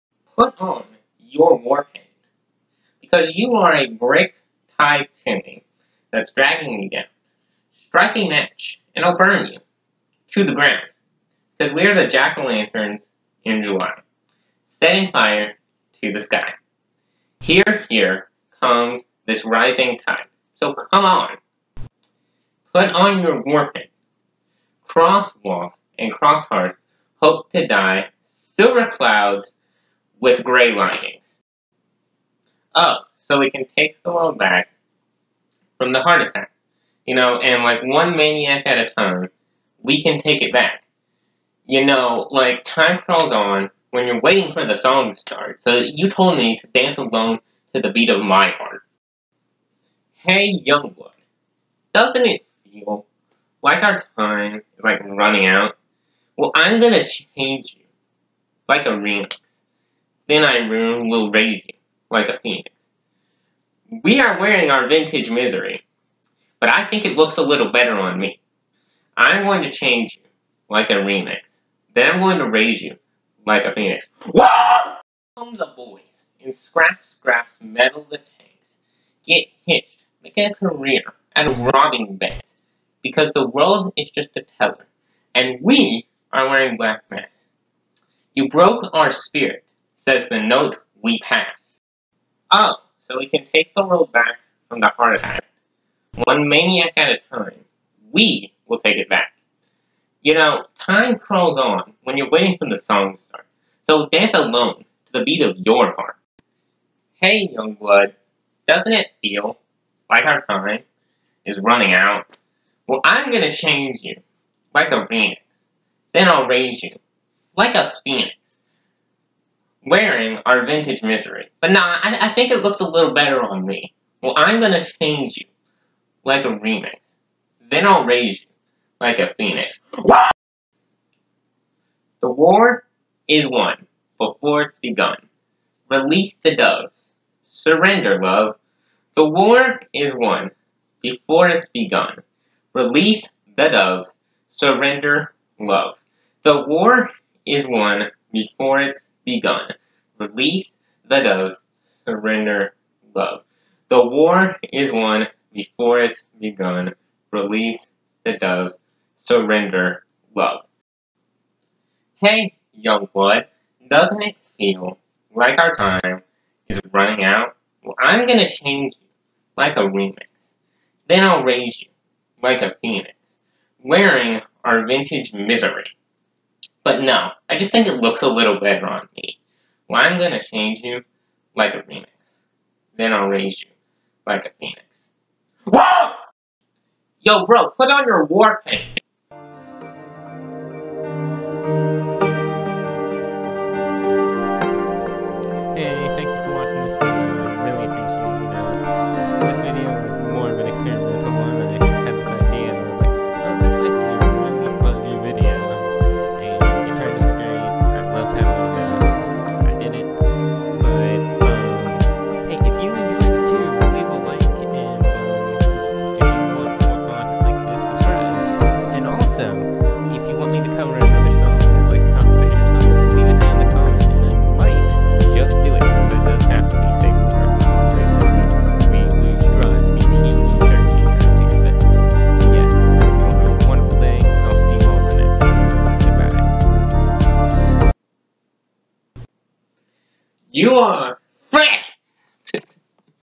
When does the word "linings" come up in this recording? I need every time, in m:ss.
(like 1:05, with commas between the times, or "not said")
0:30.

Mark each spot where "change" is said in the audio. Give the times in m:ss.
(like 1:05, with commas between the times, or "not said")
0:57, 1:09, 1:53, 2:04, 2:48, 3:00.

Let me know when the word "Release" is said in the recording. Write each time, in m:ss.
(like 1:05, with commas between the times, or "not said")
2:15, 2:22, 2:30, 2:37.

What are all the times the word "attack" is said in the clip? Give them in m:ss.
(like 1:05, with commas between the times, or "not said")
0:36, 1:35.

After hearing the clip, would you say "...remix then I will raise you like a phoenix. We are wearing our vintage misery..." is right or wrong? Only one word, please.
right.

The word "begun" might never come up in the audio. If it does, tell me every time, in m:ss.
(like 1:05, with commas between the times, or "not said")
2:14, 2:21, 2:29, 2:36.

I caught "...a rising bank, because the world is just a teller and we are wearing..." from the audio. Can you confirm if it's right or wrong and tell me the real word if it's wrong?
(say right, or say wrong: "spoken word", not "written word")
wrong: "robbing", not "rising".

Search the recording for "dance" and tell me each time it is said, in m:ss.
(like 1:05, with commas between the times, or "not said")
0:46, 1:44.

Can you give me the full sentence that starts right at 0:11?
Because we are the jack-o'-lanterns in July, setting fire to the sky.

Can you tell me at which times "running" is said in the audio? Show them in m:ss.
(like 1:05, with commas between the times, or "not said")
0:55, 1:51, 2:46.